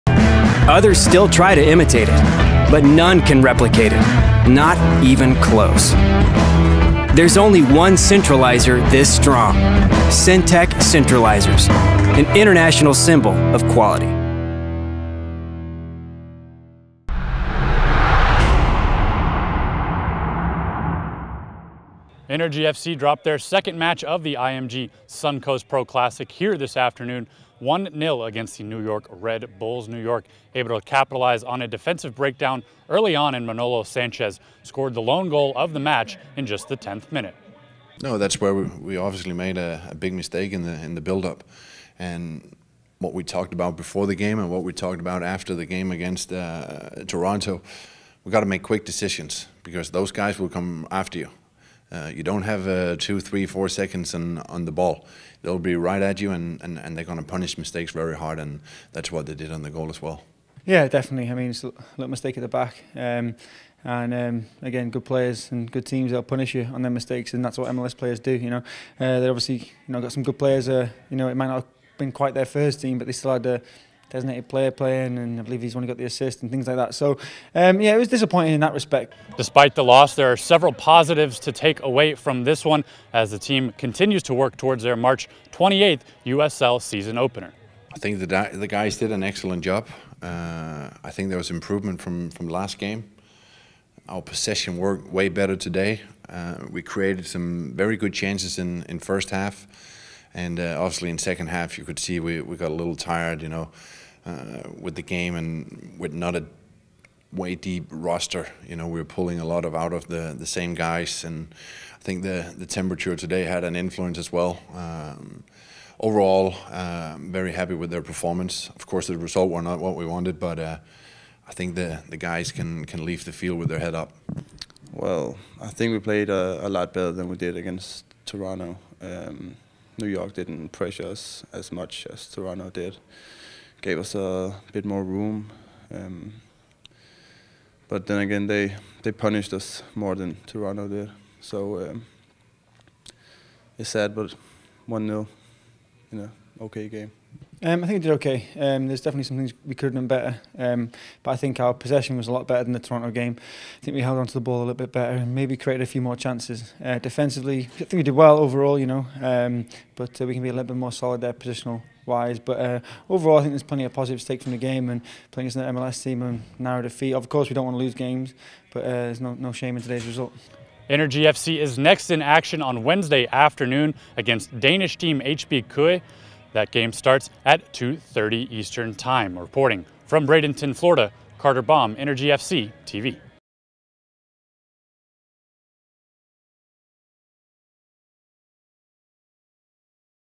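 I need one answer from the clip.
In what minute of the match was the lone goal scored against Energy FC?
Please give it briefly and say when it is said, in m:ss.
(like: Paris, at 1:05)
10th, at 0:36.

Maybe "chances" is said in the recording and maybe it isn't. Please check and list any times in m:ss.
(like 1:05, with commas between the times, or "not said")
1:38, 2:36.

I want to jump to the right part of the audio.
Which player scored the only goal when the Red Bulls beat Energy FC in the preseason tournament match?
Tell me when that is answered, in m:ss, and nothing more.
0:33.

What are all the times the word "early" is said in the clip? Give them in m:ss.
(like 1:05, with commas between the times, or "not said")
0:32.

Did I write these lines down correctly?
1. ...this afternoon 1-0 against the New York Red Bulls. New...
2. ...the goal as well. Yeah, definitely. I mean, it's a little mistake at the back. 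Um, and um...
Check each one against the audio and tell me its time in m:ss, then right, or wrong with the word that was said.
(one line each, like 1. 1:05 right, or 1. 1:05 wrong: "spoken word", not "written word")
1. 0:26 right
2. 0:59 right.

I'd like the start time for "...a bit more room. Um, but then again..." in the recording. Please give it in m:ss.
2:14.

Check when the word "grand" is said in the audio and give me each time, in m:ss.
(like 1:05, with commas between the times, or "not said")
not said.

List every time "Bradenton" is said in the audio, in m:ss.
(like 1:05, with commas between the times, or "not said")
3:00.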